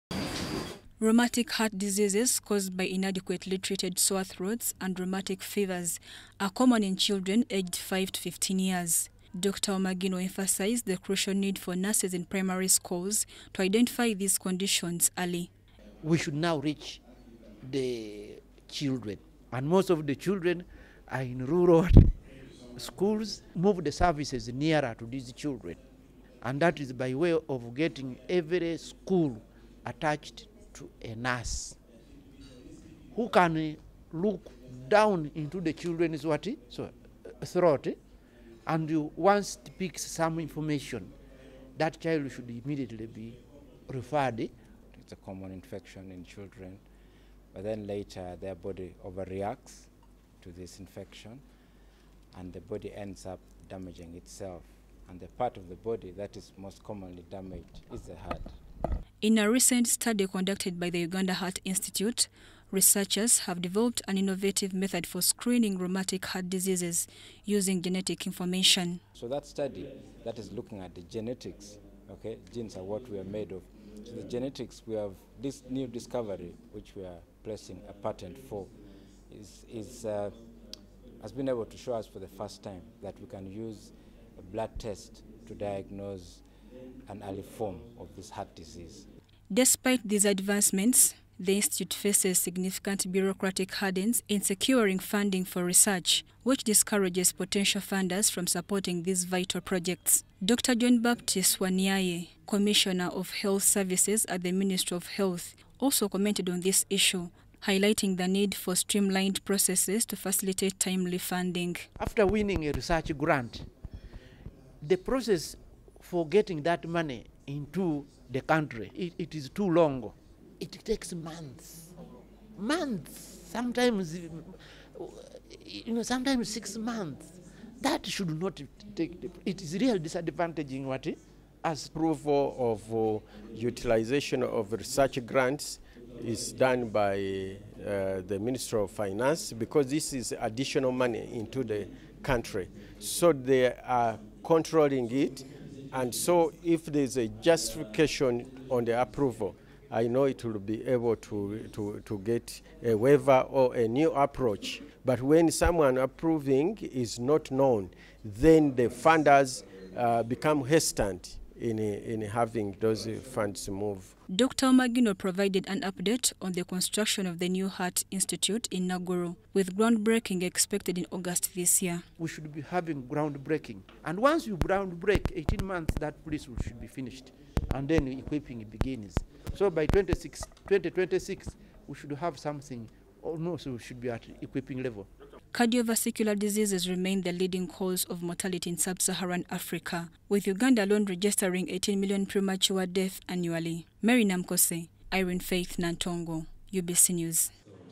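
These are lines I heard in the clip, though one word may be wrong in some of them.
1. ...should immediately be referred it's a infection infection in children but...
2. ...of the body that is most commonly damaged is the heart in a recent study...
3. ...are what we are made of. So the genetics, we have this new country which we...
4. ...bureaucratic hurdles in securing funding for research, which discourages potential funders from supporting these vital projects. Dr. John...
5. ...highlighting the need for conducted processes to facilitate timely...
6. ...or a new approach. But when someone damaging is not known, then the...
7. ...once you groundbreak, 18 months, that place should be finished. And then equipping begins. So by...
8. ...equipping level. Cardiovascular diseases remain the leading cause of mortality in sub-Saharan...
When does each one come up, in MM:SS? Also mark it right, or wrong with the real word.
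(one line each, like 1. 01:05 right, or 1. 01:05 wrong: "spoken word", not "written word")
1. 00:42 wrong: "common", not "infection"
2. 00:55 right
3. 01:12 wrong: "discovery", not "country"
4. 01:33 right
5. 01:47 wrong: "streamlined", not "conducted"
6. 02:33 wrong: "approving", not "damaging"
7. 02:54 right
8. 03:04 right.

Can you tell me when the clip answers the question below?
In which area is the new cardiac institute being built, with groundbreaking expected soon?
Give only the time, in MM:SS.
02:48.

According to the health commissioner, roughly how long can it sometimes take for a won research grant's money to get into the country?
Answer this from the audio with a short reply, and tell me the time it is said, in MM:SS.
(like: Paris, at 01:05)
6 months, at 02:06.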